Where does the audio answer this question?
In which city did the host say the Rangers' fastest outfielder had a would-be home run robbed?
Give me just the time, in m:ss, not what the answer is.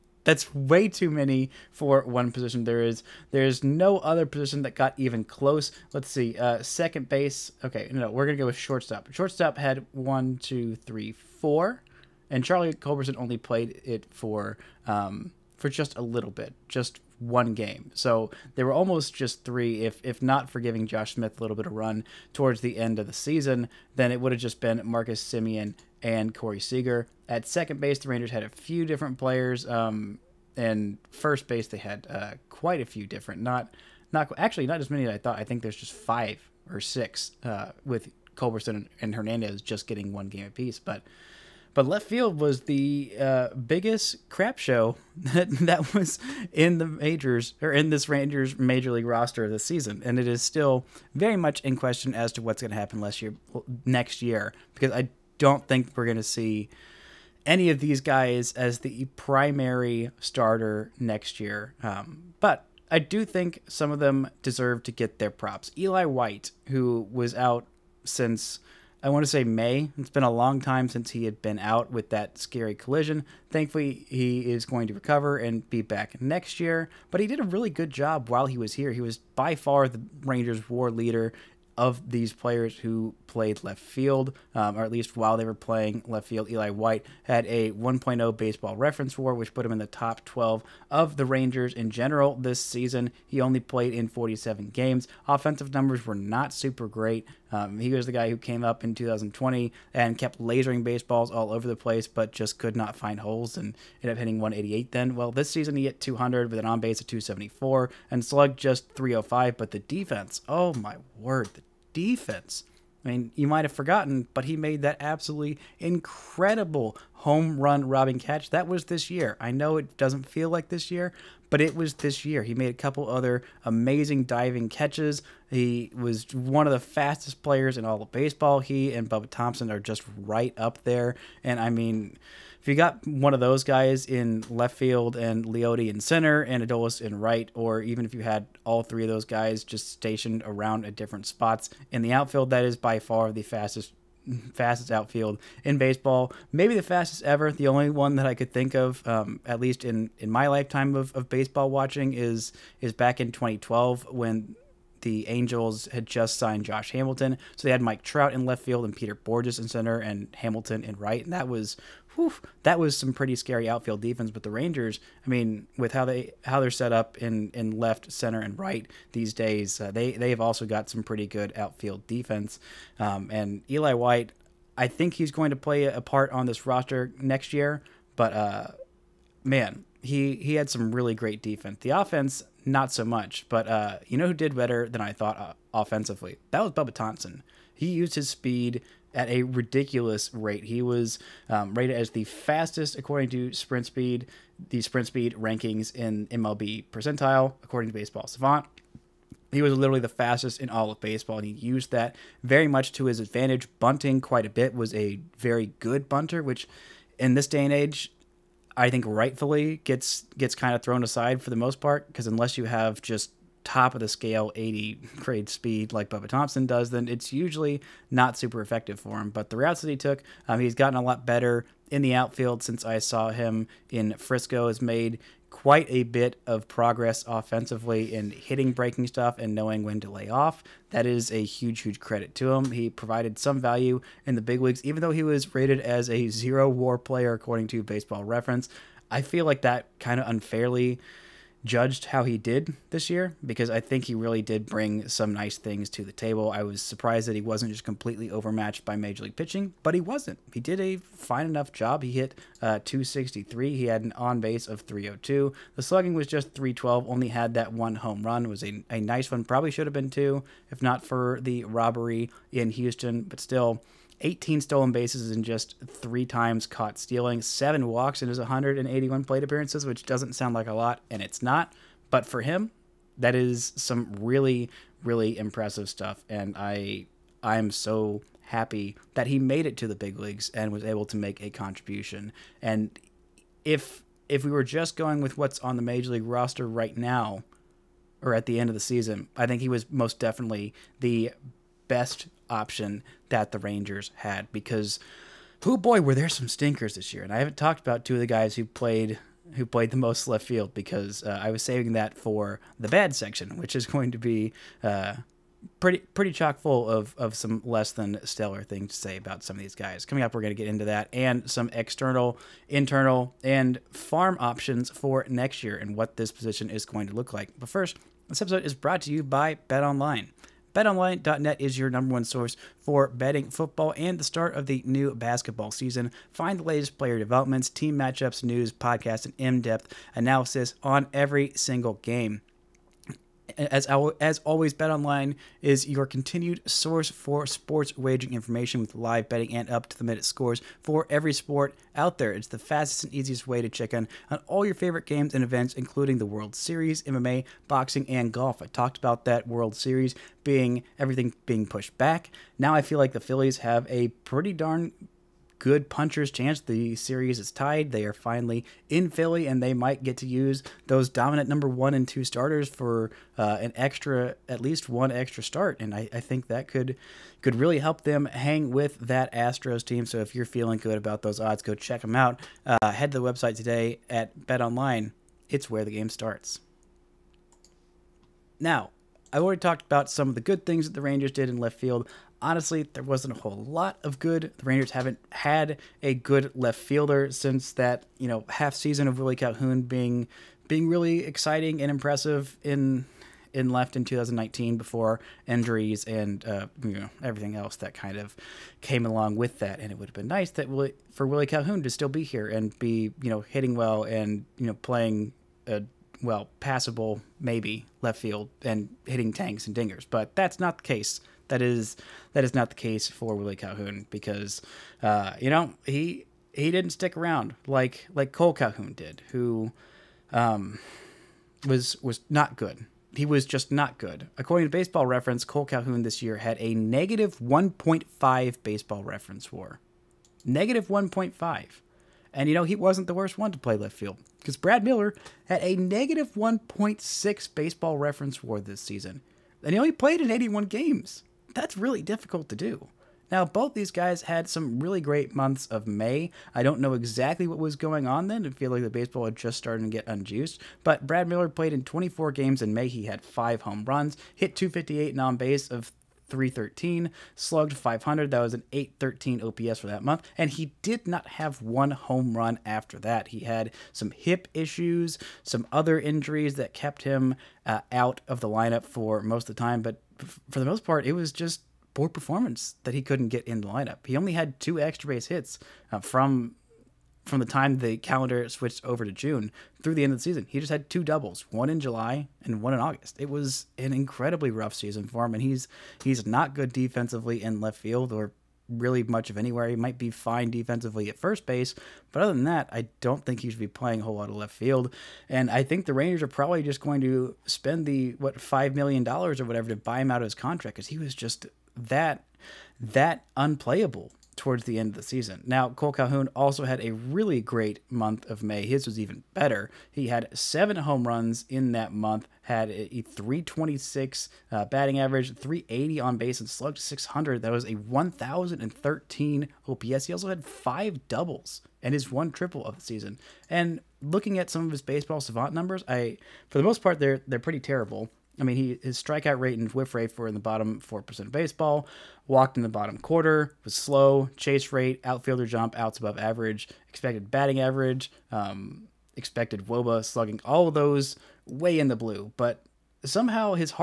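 4:22.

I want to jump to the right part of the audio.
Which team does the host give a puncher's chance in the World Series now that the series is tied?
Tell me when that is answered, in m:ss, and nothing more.
5:53.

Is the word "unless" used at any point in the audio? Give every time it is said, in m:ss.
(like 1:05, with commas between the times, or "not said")
3:32.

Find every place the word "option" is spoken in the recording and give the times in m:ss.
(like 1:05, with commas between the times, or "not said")
4:52, 5:14.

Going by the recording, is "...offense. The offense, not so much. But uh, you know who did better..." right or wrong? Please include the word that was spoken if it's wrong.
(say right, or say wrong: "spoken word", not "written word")
wrong: "defense", not "offense".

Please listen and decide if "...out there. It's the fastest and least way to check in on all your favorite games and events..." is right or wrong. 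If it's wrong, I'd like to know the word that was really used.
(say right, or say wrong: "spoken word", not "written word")
wrong: "easiest", not "least".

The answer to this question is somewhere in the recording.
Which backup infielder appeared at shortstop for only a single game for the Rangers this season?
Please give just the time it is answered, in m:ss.
0:12.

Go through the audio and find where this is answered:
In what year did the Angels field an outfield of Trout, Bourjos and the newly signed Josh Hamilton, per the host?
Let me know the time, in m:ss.
2:33.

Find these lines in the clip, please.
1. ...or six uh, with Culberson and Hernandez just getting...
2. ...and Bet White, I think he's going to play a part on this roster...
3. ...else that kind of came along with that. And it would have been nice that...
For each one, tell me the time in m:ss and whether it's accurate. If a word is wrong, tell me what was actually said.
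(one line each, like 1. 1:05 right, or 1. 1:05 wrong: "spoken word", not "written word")
1. 0:36 right
2. 2:53 wrong: "Eli", not "Bet"
3. 6:37 right.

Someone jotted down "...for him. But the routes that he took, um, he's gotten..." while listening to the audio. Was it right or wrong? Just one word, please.
right.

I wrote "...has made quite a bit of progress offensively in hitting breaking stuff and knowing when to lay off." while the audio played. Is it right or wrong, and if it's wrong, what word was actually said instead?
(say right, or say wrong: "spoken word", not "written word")
right.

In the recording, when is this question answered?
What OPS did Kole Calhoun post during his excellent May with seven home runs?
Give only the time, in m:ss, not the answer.
8:37.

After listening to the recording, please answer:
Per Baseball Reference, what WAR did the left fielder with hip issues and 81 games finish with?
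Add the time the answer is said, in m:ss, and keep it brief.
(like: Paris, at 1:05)
-1.6, at 7:15.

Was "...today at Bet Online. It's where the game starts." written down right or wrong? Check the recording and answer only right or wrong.
right.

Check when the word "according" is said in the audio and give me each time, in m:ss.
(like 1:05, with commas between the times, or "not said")
3:12, 3:17, 3:57, 7:04.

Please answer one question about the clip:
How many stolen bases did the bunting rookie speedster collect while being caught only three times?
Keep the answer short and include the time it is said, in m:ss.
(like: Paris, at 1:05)
18, at 4:24.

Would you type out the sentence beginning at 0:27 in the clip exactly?
At second base, the Rangers had a few different players, um, and first base they had uh, quite a few different.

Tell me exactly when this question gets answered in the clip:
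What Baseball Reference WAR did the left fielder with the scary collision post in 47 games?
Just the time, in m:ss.
1:27.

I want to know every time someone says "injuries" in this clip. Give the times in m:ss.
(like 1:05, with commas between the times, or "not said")
6:35, 7:45.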